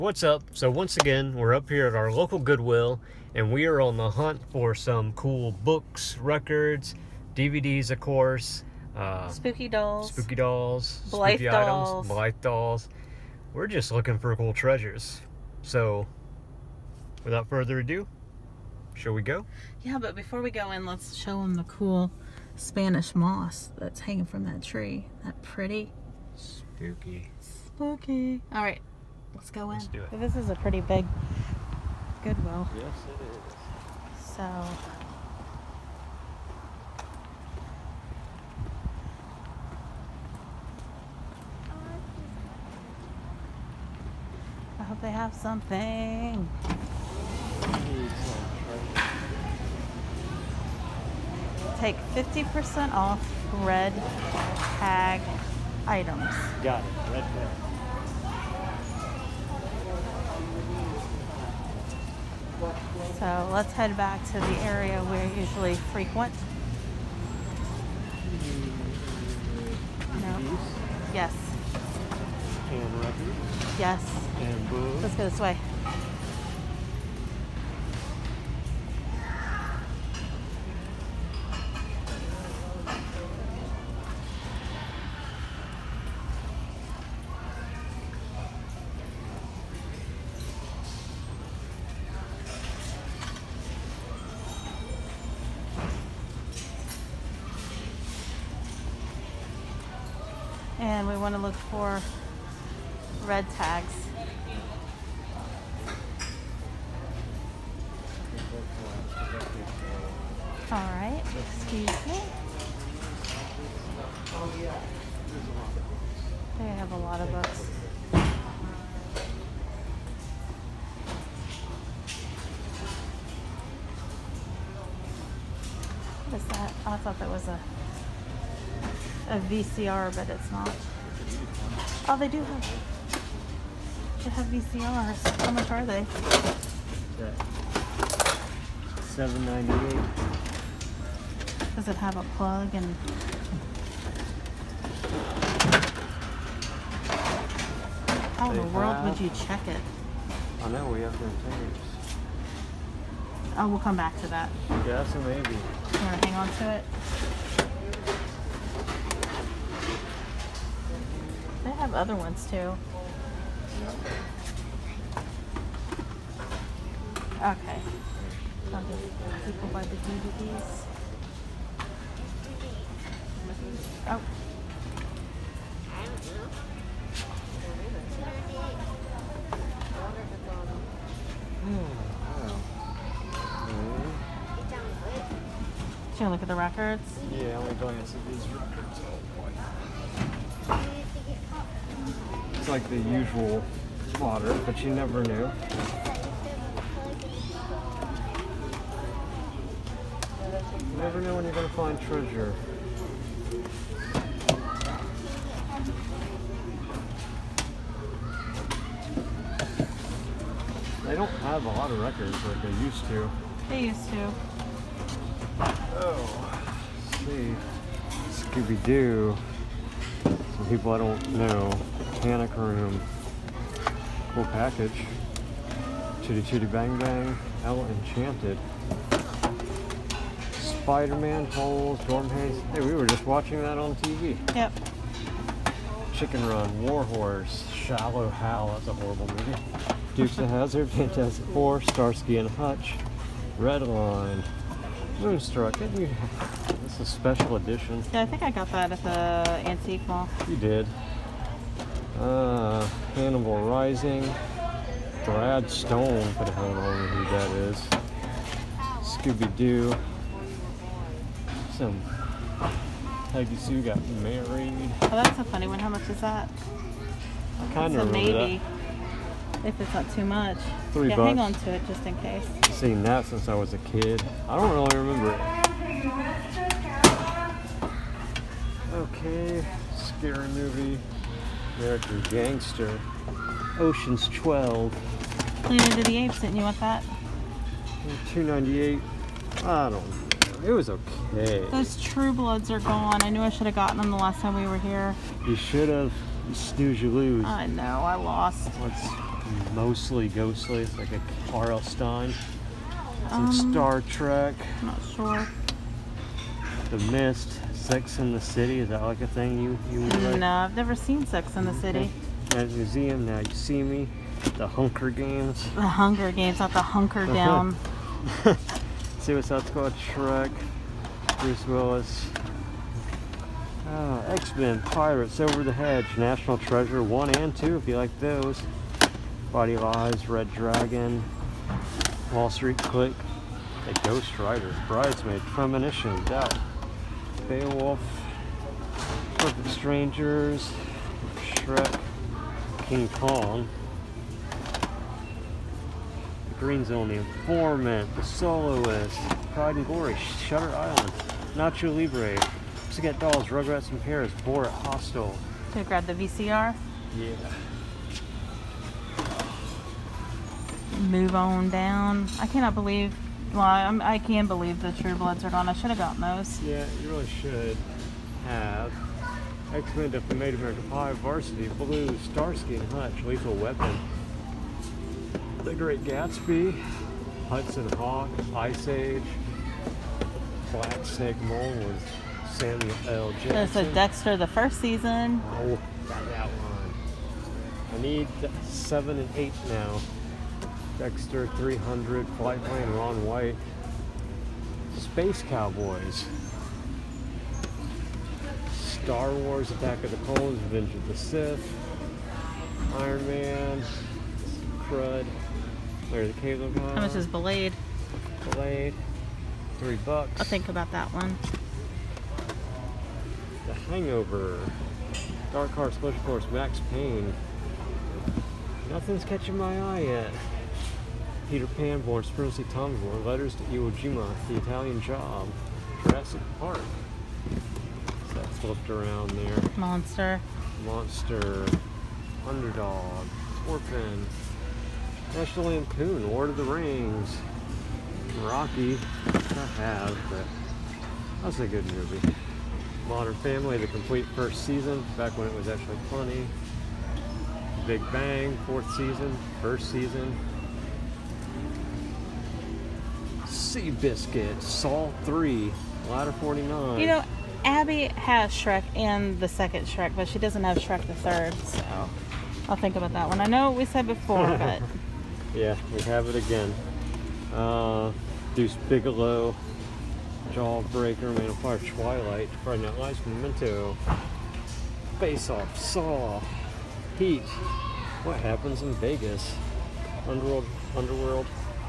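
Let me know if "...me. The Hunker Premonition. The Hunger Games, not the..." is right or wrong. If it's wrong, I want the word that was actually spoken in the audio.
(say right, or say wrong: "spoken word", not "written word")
wrong: "Games", not "Premonition".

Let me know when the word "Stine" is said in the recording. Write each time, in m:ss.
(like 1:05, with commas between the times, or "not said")
5:01.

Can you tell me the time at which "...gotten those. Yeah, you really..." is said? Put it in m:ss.
6:05.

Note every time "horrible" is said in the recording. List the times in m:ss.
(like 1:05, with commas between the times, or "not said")
3:58.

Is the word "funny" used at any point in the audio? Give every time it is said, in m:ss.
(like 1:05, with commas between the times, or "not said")
4:25, 7:26.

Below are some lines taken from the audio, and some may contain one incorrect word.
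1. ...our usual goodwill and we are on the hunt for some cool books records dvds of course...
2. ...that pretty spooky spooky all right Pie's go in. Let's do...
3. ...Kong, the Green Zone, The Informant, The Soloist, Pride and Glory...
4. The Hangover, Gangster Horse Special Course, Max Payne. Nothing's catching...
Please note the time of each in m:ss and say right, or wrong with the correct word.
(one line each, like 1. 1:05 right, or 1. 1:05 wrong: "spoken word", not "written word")
1. 0:01 wrong: "local", not "usual"
2. 0:25 wrong: "Let", not "Pie"
3. 5:43 right
4. 6:53 wrong: "Dark", not "Gangster".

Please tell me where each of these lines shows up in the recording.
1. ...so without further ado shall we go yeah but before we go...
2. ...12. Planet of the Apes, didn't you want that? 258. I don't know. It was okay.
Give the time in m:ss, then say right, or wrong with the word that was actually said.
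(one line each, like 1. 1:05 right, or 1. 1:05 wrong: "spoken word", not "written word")
1. 0:15 right
2. 4:44 wrong: "298", not "258".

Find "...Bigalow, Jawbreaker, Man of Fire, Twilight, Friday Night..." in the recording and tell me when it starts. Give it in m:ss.
7:48.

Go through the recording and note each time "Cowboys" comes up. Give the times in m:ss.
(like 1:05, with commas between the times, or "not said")
6:35.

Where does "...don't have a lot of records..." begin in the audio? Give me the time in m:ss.
3:31.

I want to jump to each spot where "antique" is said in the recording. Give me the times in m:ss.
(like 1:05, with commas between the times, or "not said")
4:09.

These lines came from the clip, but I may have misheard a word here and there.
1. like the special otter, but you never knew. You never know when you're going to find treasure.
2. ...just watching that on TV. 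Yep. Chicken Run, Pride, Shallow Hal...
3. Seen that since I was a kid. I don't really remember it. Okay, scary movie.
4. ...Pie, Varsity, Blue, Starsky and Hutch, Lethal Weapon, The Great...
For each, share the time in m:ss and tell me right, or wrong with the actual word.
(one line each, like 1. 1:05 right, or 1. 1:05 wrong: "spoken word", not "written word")
1. 3:12 wrong: "usual", not "special"
2. 3:53 wrong: "Warhorse", not "Pride"
3. 4:32 right
4. 6:10 right.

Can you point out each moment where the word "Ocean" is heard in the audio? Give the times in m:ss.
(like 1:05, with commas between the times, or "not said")
4:43.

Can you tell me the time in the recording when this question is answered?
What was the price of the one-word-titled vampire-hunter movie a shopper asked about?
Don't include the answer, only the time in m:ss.
6:49.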